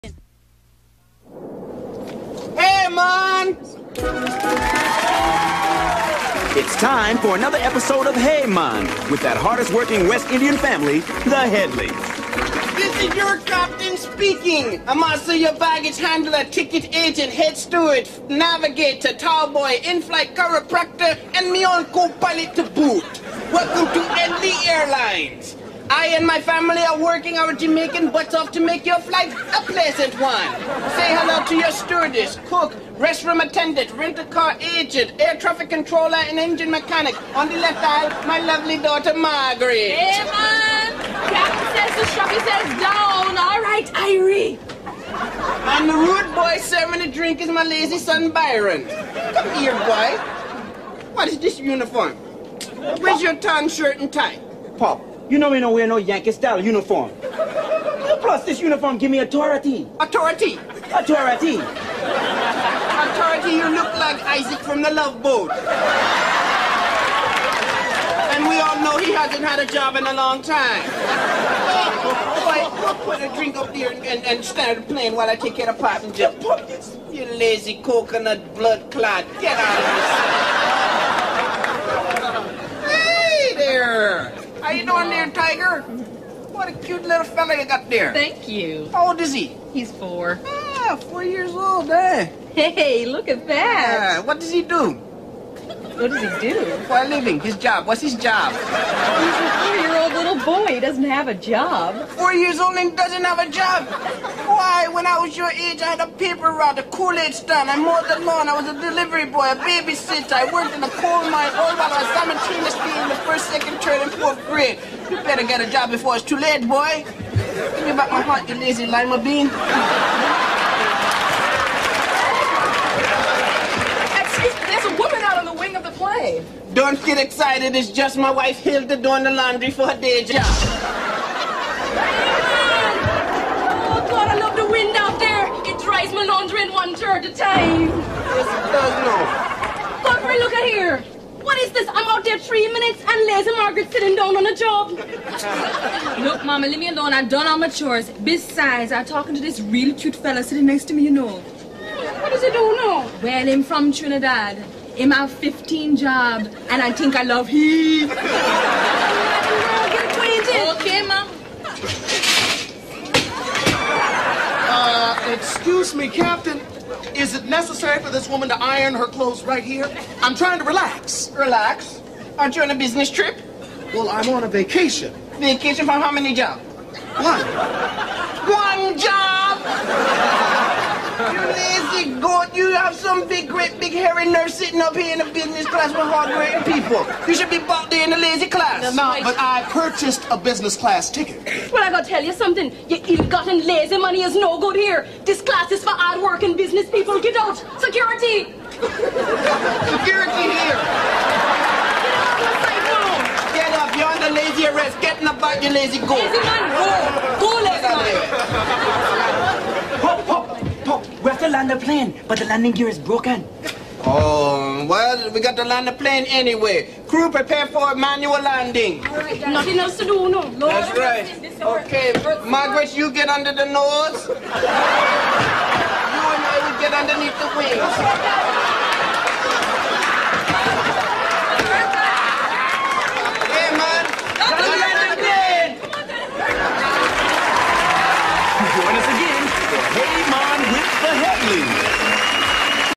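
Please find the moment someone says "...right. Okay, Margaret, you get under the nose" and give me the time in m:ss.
3:40.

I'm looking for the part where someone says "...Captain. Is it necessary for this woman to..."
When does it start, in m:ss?
2:46.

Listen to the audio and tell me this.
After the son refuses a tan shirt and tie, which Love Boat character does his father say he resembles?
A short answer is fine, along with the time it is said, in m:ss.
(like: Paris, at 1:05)
Isaac, at 1:04.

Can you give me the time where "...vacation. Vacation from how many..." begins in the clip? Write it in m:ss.
2:54.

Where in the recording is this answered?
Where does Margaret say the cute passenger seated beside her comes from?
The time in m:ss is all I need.
2:33.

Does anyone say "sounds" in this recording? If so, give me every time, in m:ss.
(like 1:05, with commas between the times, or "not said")
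not said.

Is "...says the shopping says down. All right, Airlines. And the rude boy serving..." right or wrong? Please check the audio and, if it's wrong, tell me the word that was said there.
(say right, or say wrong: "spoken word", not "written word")
wrong: "Irie", not "Airlines".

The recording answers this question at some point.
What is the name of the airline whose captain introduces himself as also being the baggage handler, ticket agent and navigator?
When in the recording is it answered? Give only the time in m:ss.
0:24.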